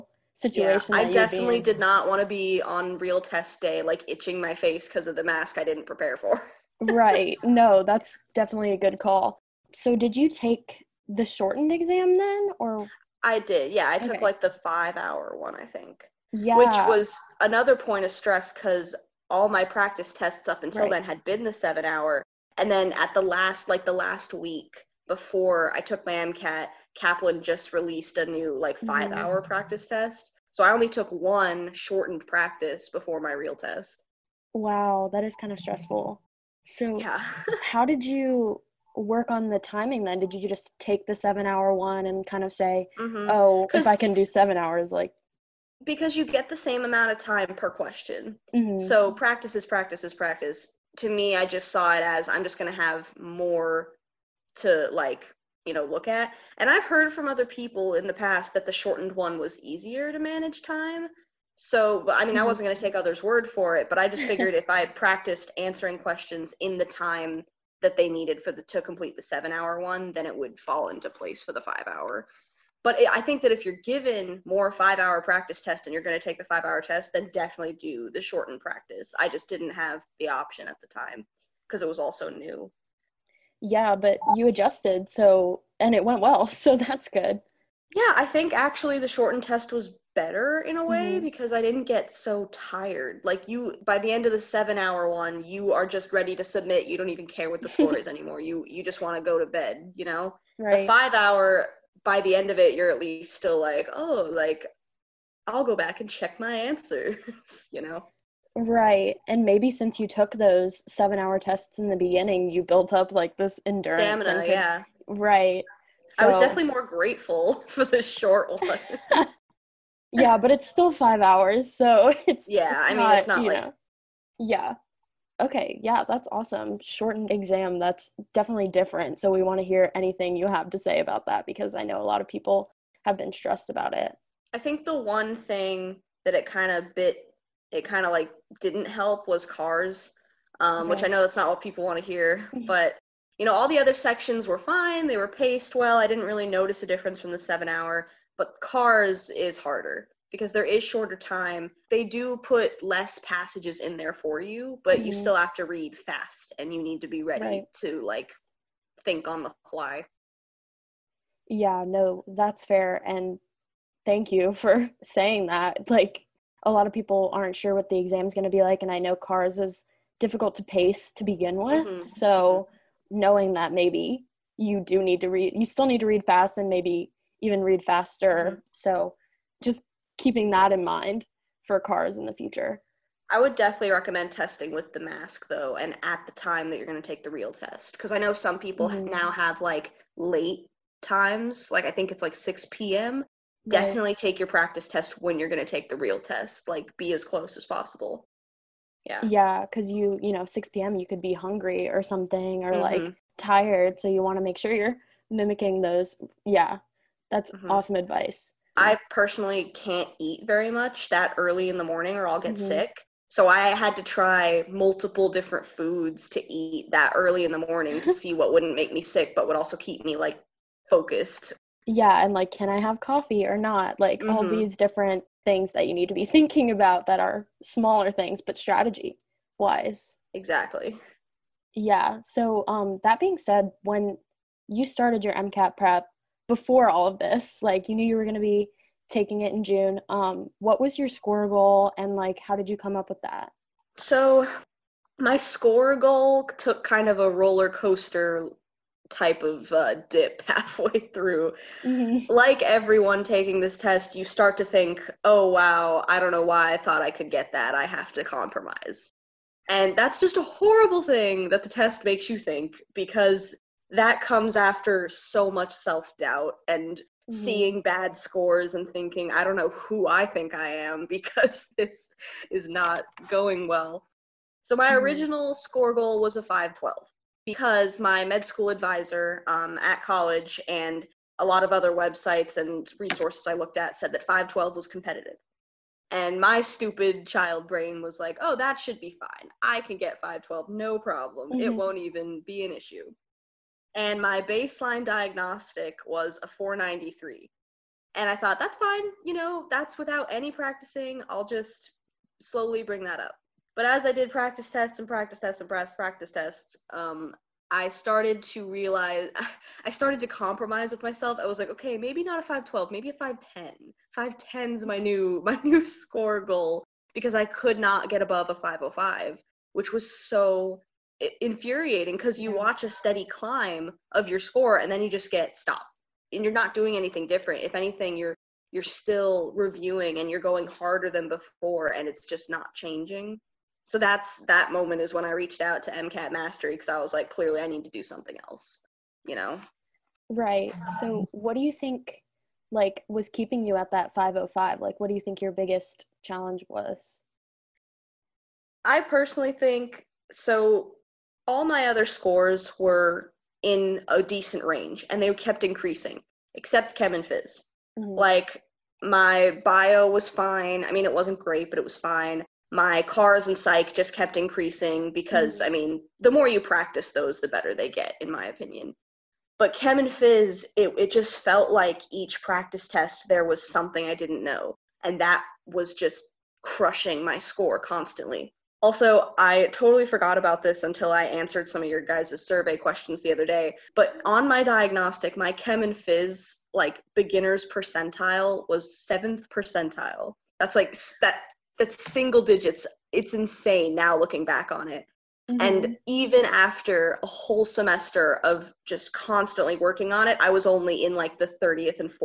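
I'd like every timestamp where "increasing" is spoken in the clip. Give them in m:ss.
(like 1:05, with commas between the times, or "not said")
5:55, 6:04.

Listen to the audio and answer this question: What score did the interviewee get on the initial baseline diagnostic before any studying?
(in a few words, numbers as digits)
493.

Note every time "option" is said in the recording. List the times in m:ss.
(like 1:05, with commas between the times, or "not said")
1:20.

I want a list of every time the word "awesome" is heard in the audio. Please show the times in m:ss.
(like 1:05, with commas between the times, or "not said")
2:06, 3:27.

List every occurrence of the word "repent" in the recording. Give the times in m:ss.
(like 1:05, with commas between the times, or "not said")
not said.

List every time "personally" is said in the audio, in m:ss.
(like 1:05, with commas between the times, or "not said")
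3:29, 5:49.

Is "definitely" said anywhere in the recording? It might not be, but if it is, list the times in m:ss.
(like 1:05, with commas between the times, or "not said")
0:01, 0:08, 1:17, 1:56, 2:08, 3:03, 3:13.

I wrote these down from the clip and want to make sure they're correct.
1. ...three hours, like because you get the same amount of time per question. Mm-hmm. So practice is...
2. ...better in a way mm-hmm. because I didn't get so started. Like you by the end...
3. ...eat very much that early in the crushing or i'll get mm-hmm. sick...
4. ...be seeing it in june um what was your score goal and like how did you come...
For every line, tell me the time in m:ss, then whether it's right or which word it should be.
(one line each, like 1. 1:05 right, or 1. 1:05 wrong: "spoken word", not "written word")
1. 0:44 wrong: "seven", not "three"
2. 1:30 wrong: "tired", not "started"
3. 3:30 wrong: "morning", not "crushing"
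4. 3:58 wrong: "taking", not "seeing".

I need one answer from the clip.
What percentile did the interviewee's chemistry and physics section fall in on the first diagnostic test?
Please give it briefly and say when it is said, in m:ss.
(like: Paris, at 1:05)
7th percentile, at 6:28.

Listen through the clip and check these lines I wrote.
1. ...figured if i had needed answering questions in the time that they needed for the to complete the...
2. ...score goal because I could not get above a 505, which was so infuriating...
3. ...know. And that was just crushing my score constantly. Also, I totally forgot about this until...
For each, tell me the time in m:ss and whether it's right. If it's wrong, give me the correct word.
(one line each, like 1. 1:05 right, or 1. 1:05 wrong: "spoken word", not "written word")
1. 1:04 wrong: "practiced", not "needed"
2. 5:15 right
3. 6:14 right.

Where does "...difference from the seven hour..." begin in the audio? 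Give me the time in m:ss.
2:26.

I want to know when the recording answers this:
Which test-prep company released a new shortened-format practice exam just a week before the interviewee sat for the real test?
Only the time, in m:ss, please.
0:26.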